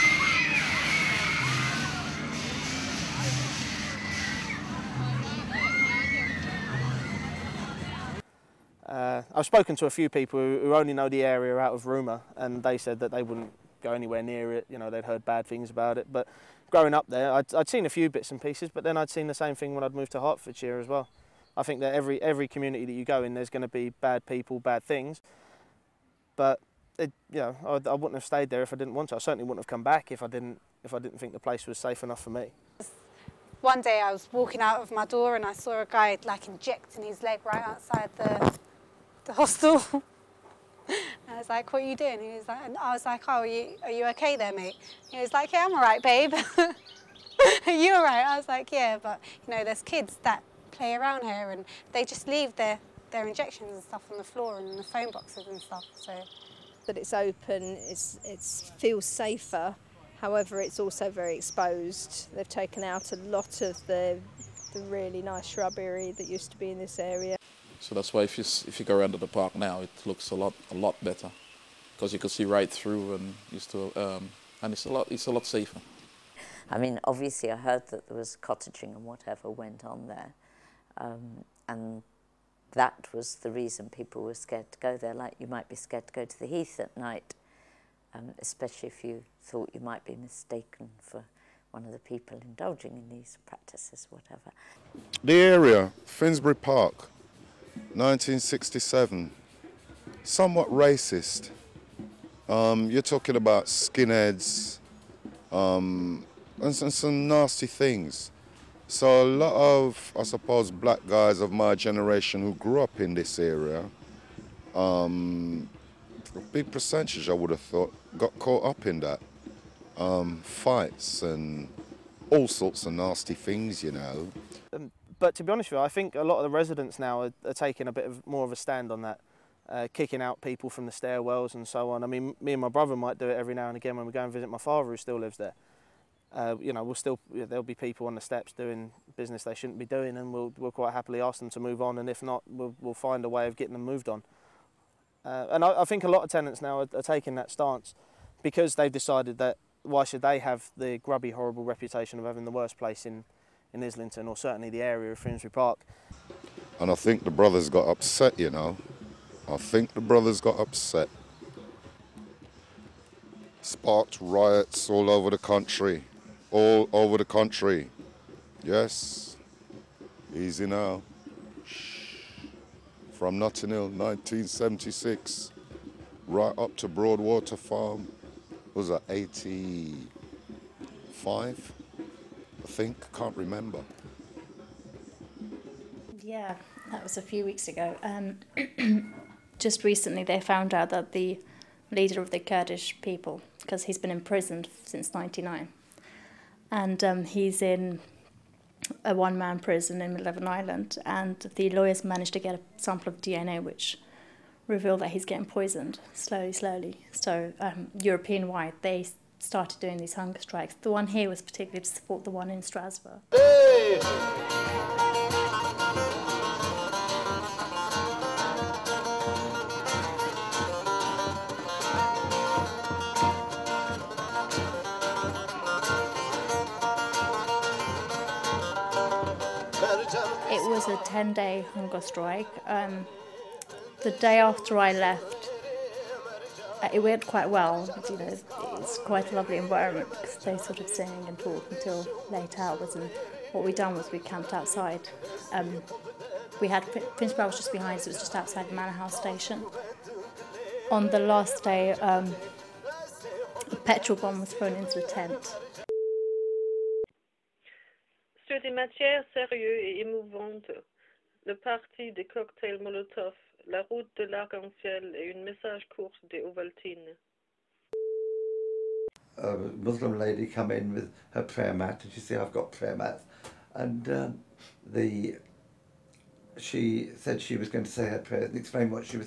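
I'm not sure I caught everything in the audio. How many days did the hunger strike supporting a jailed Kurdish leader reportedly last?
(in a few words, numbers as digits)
10.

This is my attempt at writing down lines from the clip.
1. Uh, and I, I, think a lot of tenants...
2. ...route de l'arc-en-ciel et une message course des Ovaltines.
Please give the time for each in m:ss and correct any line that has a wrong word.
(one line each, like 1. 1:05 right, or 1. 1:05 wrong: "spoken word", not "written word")
1. 2:25 right
2. 4:23 right.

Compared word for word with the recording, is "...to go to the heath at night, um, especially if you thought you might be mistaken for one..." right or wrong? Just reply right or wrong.
right.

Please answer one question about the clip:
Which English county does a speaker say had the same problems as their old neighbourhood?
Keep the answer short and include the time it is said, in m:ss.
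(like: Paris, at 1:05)
Hertfordshire, at 0:20.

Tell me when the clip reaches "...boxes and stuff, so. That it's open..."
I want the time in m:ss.
0:55.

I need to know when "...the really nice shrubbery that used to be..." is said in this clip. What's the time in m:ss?
1:04.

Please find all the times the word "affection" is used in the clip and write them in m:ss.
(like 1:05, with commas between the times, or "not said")
not said.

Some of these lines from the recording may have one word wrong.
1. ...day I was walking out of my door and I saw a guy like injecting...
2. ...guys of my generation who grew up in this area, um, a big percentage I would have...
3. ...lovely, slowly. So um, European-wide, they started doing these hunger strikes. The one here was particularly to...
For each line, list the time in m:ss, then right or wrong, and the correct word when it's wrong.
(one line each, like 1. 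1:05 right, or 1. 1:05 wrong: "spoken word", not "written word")
1. 0:33 right
2. 1:51 right
3. 3:26 wrong: "slowly", not "lovely".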